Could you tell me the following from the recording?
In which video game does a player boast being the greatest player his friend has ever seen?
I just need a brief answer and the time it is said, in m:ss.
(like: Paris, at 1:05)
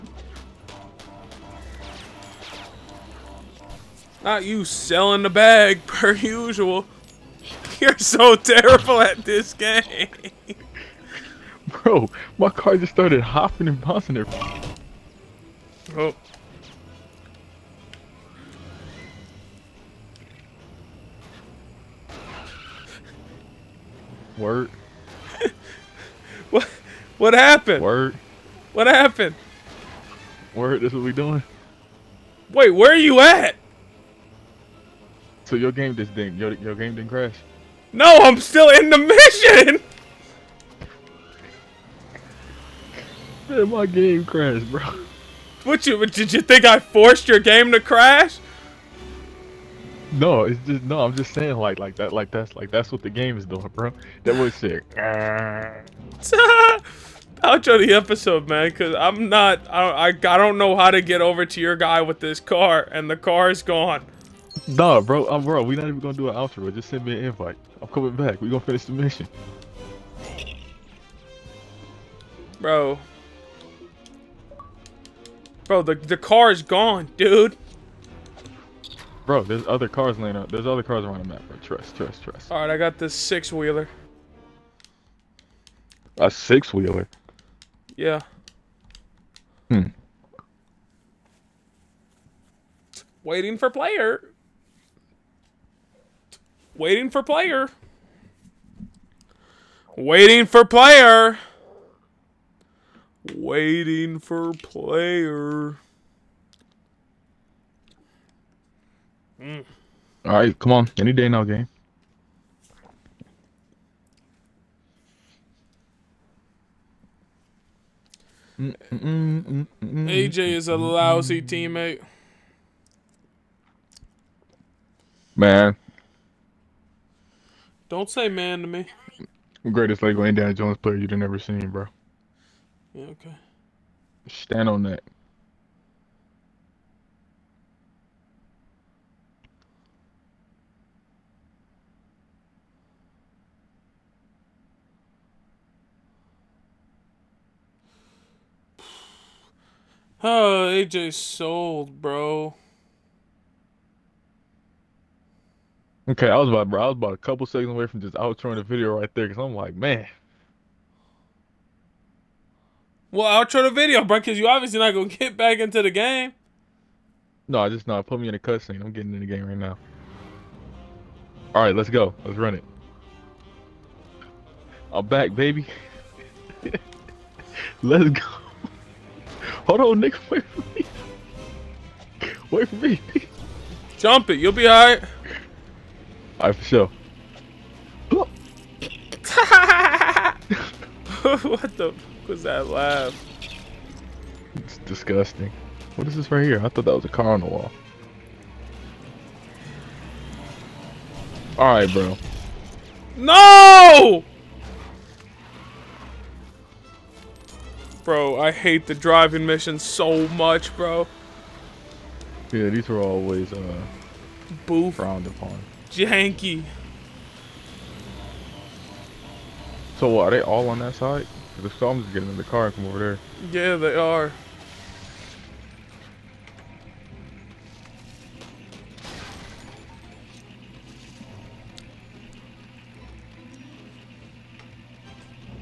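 Lego Indiana Jones, at 2:10.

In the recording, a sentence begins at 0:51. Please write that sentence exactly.
I'm just saying like like that like that's like that's what the game is doing, bro.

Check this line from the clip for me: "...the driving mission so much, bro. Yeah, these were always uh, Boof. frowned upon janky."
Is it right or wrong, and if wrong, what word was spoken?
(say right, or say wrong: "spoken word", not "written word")
right.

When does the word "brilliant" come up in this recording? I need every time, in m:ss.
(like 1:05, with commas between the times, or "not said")
not said.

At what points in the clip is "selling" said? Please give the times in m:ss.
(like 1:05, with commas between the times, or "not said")
0:04.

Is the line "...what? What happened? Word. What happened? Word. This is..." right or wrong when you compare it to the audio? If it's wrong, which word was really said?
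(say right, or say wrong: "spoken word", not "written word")
right.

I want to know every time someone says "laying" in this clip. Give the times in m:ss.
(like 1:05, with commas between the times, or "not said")
1:20.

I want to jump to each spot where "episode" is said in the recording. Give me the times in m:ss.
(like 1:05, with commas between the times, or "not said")
0:57.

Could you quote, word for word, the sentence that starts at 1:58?
Mm -mm -mm AJ is a lousy teammate.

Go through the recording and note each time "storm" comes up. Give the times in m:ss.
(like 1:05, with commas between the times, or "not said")
3:41.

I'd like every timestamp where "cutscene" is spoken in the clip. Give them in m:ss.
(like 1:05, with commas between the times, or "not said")
2:48.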